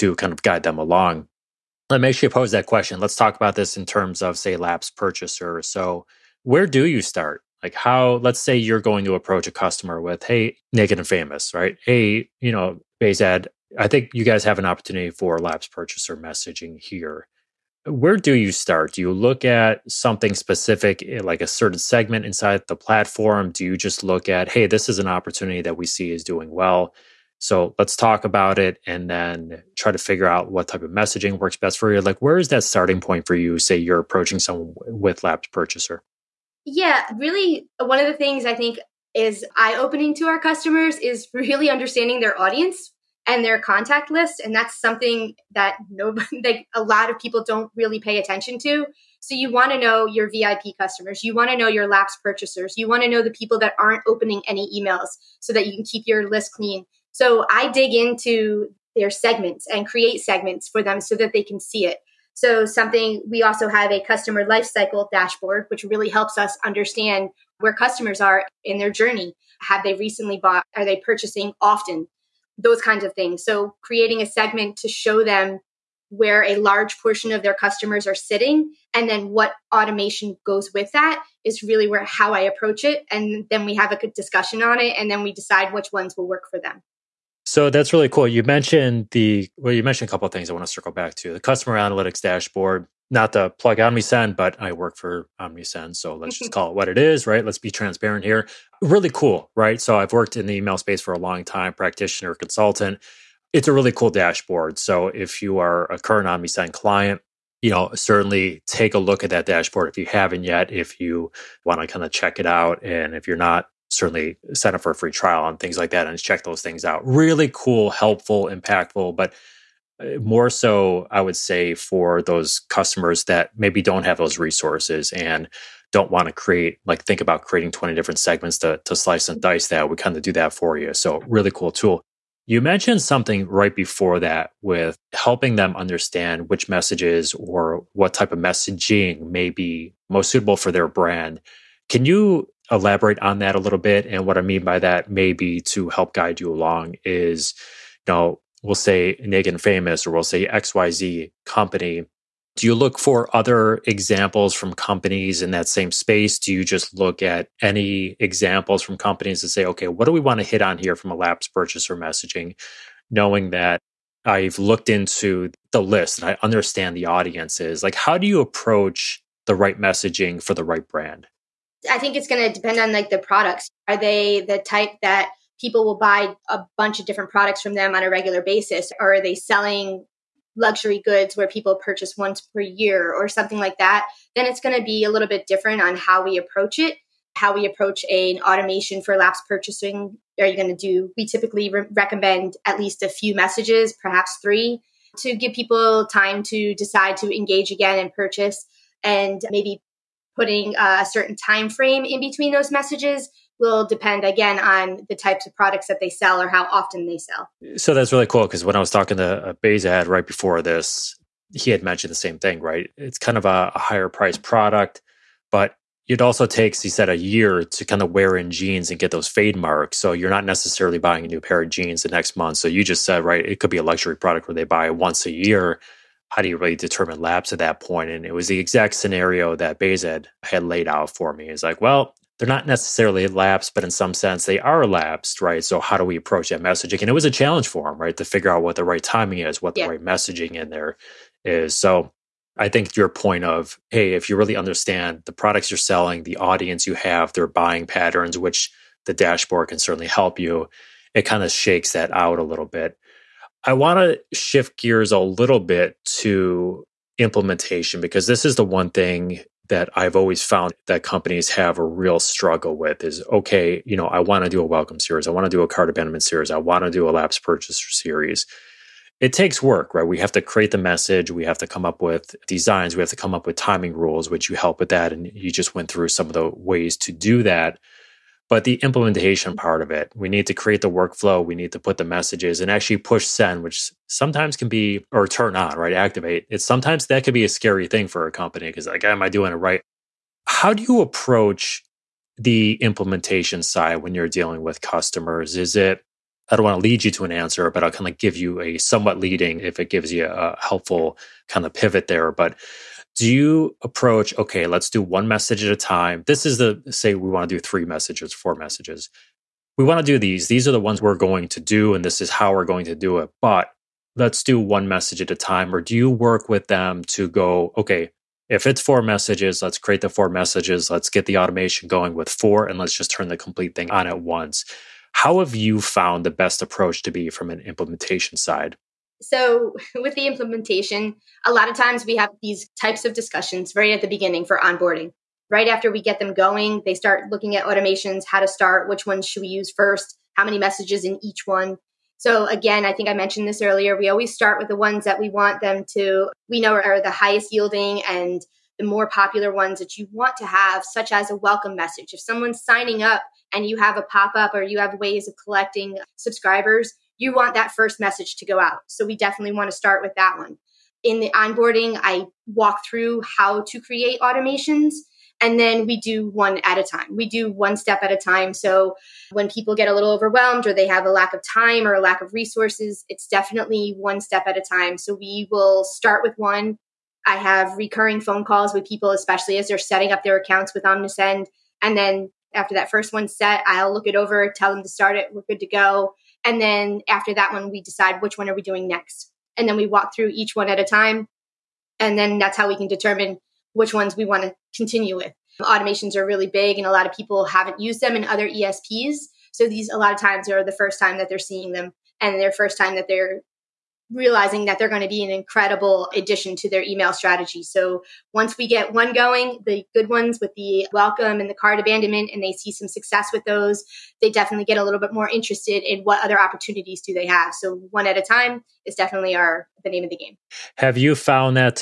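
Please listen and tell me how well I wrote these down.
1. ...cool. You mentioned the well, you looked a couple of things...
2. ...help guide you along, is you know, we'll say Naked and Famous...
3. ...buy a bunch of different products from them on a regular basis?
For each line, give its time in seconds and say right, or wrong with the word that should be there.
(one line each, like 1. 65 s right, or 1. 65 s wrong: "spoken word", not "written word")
1. 88 s wrong: "mentioned", not "looked"
2. 145 s right
3. 175 s right.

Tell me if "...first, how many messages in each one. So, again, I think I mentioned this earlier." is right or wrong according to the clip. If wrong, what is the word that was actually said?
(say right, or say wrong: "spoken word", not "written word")
right.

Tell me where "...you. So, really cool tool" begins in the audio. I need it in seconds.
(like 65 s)
130 s.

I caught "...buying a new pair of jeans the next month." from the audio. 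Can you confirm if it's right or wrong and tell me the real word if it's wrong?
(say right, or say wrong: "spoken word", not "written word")
right.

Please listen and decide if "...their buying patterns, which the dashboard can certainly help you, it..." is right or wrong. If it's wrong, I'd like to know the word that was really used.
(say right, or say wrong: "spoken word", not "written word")
right.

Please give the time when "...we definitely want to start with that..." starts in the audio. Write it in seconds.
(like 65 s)
359 s.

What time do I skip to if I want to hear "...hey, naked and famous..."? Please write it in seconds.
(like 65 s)
10 s.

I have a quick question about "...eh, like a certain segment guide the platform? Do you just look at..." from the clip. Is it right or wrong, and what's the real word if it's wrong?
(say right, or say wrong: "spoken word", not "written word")
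wrong: "inside", not "guide".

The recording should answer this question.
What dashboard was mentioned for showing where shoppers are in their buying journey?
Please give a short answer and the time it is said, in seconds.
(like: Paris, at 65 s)
customer lifecycle dashboard, at 64 s.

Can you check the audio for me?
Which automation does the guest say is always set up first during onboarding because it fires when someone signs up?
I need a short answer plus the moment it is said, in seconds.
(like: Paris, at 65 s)
welcome message, at 351 s.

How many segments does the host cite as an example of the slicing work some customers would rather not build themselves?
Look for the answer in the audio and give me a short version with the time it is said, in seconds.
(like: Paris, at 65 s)
20, at 127 s.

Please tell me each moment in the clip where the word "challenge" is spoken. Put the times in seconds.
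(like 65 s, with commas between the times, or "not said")
237 s.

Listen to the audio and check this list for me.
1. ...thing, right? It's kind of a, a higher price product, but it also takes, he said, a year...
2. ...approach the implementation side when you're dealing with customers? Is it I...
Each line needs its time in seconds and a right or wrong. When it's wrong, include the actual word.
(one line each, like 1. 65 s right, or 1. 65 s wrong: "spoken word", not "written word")
1. 212 s right
2. 291 s right.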